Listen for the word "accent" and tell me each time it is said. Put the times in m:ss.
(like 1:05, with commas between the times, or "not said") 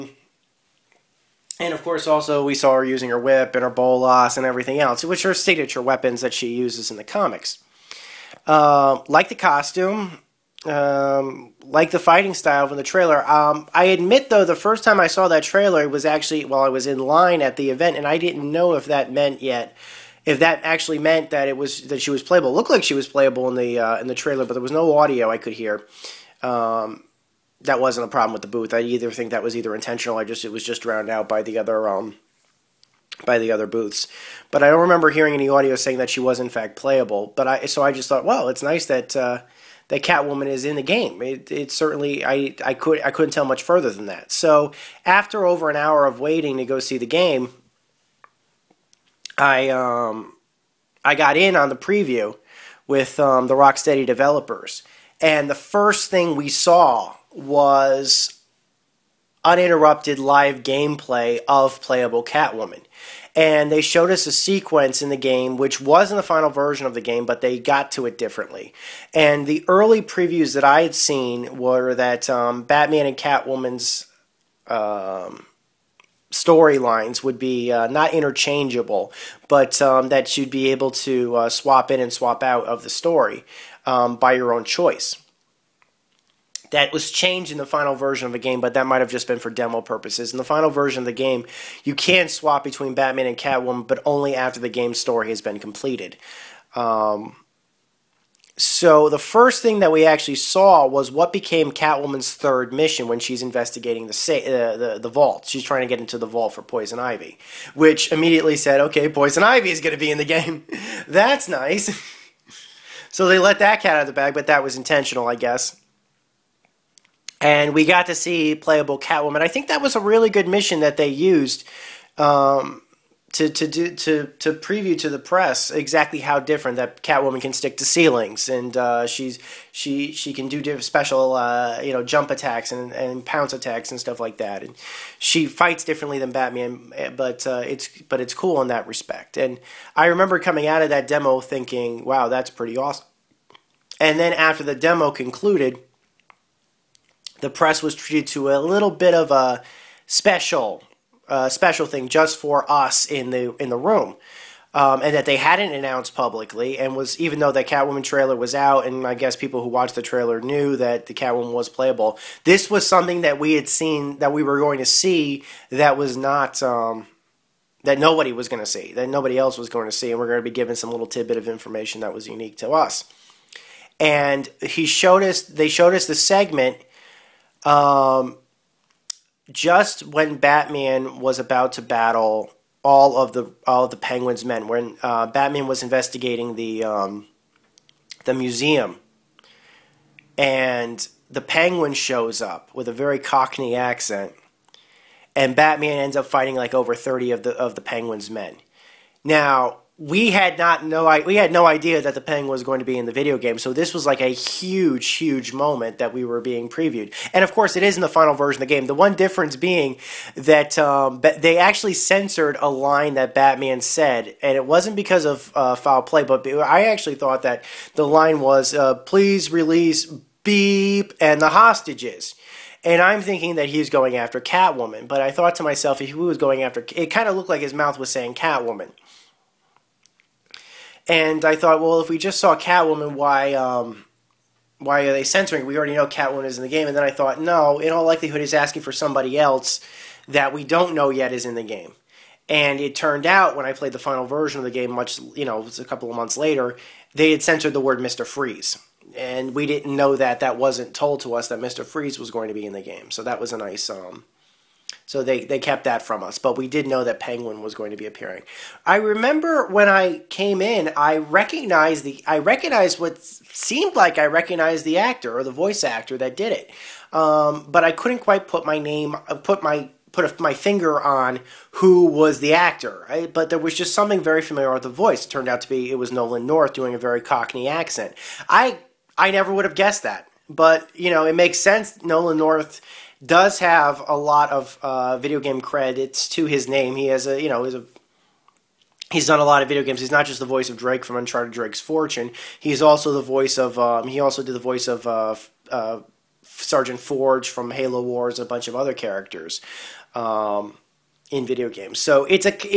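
3:13, 4:37.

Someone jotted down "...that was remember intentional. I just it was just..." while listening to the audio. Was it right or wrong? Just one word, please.
wrong.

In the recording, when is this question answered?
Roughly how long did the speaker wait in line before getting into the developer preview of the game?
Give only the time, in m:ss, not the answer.
0:45.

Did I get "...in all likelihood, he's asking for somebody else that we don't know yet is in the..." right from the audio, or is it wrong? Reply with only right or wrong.
right.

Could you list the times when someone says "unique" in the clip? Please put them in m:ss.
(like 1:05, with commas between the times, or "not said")
2:52.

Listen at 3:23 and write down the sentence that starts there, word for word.
So this was like a huge, huge moment that we were being previewed.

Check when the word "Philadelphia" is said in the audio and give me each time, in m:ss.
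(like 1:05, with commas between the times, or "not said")
not said.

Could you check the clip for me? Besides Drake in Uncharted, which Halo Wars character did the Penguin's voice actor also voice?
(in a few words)
Sergeant Forge.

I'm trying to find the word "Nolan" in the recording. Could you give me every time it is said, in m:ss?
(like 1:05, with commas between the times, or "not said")
4:36, 4:42.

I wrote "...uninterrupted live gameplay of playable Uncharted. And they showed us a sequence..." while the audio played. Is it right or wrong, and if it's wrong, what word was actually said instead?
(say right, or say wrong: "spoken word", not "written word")
wrong: "Catwoman", not "Uncharted".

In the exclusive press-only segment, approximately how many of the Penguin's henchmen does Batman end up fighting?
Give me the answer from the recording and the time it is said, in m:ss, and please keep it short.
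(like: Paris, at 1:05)
over 30, at 3:16.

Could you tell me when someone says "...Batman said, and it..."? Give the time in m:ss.
3:33.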